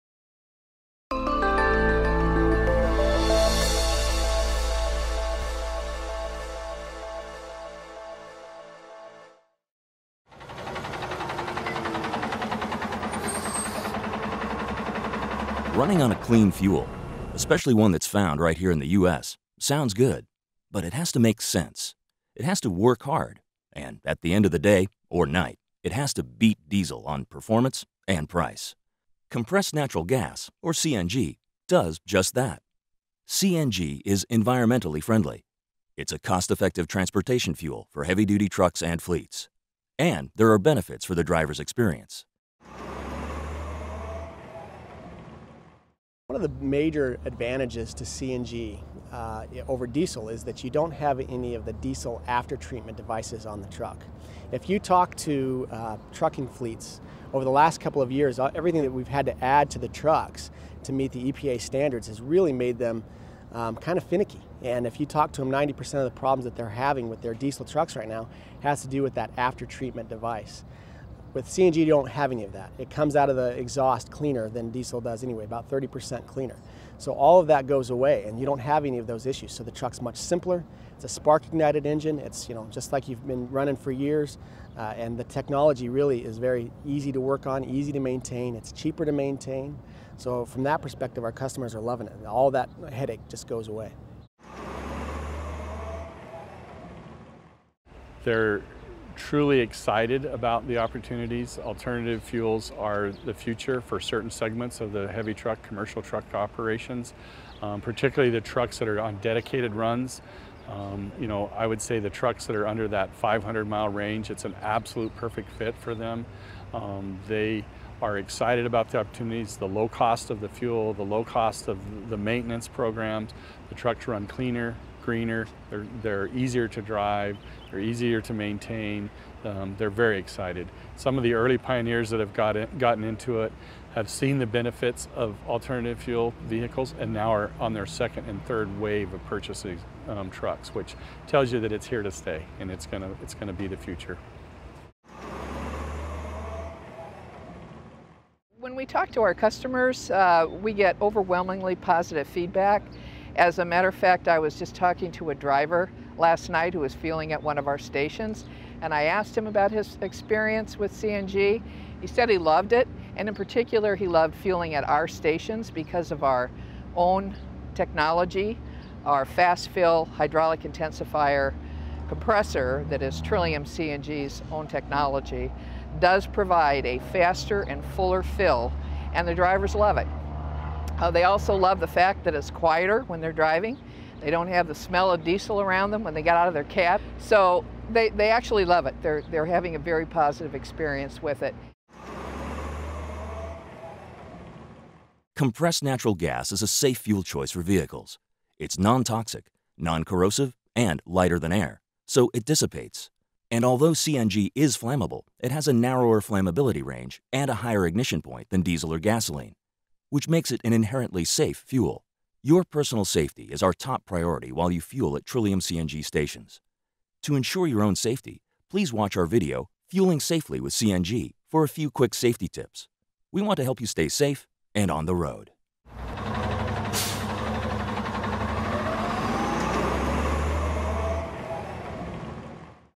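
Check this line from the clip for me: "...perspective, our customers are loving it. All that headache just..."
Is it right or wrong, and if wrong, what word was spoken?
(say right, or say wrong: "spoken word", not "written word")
right.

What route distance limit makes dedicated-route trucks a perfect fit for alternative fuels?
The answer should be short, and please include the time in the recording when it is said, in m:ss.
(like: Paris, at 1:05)
500 miles, at 1:53.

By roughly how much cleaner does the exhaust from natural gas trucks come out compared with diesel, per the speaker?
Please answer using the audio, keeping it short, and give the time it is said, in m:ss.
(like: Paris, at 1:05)
30%, at 1:15.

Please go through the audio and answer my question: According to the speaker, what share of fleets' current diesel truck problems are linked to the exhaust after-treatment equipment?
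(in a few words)
90%.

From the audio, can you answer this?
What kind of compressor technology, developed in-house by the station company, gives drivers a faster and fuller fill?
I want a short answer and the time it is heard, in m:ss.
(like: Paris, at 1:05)
fast fill hydraulic intensifier compressor, at 2:49.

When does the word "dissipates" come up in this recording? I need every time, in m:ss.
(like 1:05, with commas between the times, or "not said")
3:22.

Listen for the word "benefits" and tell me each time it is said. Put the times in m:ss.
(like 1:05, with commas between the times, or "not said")
0:40, 2:14.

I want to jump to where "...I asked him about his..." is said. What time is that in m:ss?
2:38.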